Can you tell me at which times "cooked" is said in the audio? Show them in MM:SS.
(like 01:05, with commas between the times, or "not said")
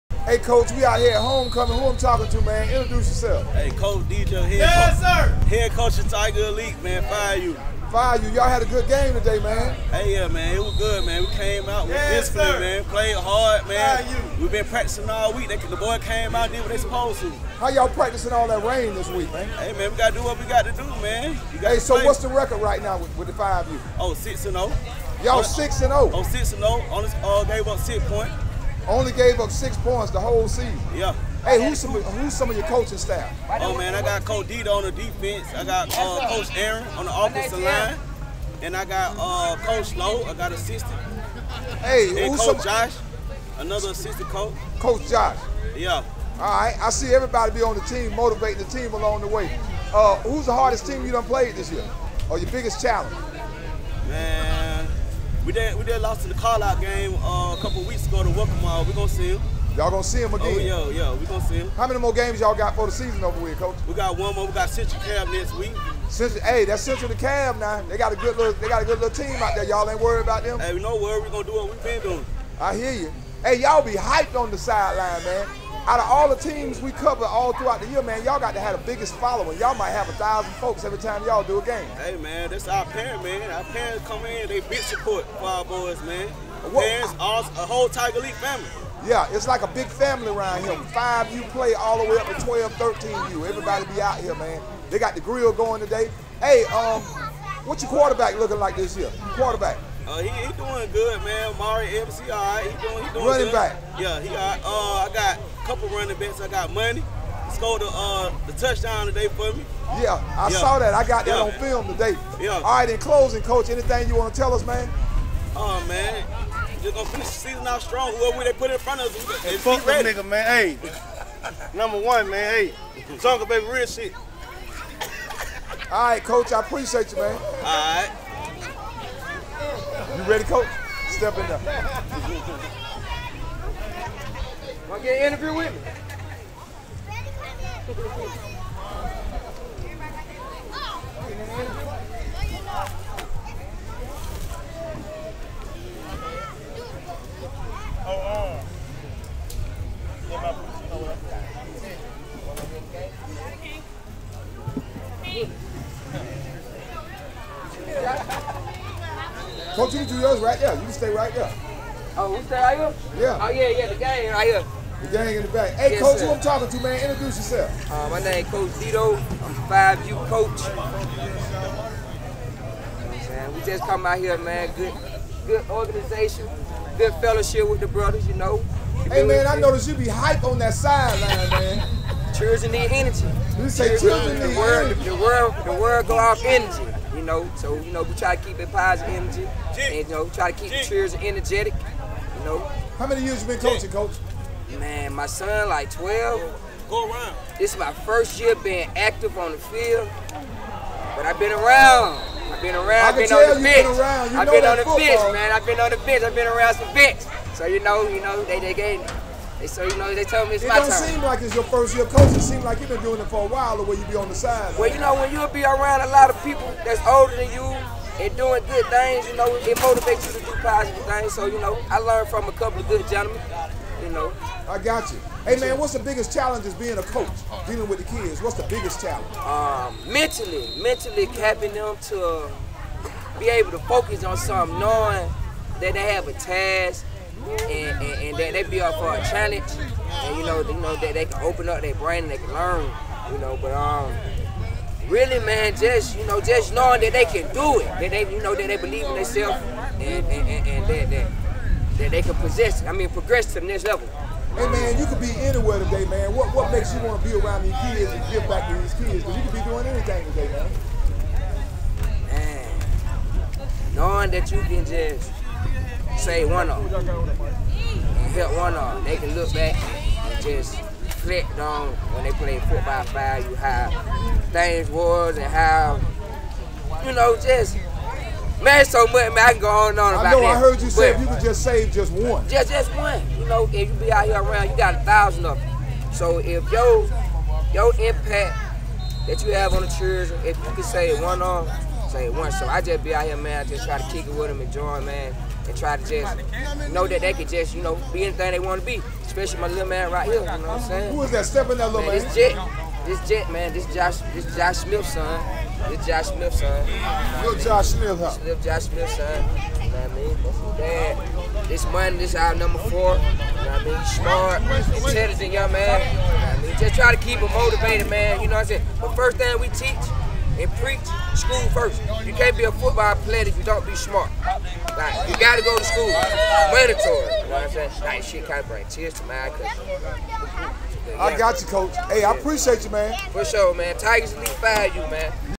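not said.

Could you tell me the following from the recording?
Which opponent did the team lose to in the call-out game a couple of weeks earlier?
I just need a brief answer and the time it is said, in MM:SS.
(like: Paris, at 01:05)
Welcome All, at 00:58.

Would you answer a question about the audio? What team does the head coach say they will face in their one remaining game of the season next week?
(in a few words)
Central Cab.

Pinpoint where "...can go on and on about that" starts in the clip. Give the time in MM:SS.
04:39.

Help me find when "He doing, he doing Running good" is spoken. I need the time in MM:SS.
01:42.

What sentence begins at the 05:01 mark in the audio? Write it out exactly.
Who is that stepping that little man?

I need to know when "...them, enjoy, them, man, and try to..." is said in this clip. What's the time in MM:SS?
04:54.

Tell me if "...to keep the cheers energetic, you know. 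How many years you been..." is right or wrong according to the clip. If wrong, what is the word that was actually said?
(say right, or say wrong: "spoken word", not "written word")
right.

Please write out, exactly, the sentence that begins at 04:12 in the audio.
I mean, progress to the next level.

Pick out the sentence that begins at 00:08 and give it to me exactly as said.
Y'all had a good game today, man.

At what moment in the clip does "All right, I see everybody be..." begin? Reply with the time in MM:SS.
00:46.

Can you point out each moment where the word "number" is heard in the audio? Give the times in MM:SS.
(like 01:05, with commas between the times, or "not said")
02:01, 05:12.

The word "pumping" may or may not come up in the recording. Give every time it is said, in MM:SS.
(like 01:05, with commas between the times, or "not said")
not said.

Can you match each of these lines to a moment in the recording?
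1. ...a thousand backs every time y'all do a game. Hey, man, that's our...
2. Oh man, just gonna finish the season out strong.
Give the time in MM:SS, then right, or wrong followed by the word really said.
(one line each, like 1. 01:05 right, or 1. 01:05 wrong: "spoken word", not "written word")
1. 01:20 wrong: "folks", not "backs"
2. 01:55 right.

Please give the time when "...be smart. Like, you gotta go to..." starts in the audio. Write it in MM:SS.
05:23.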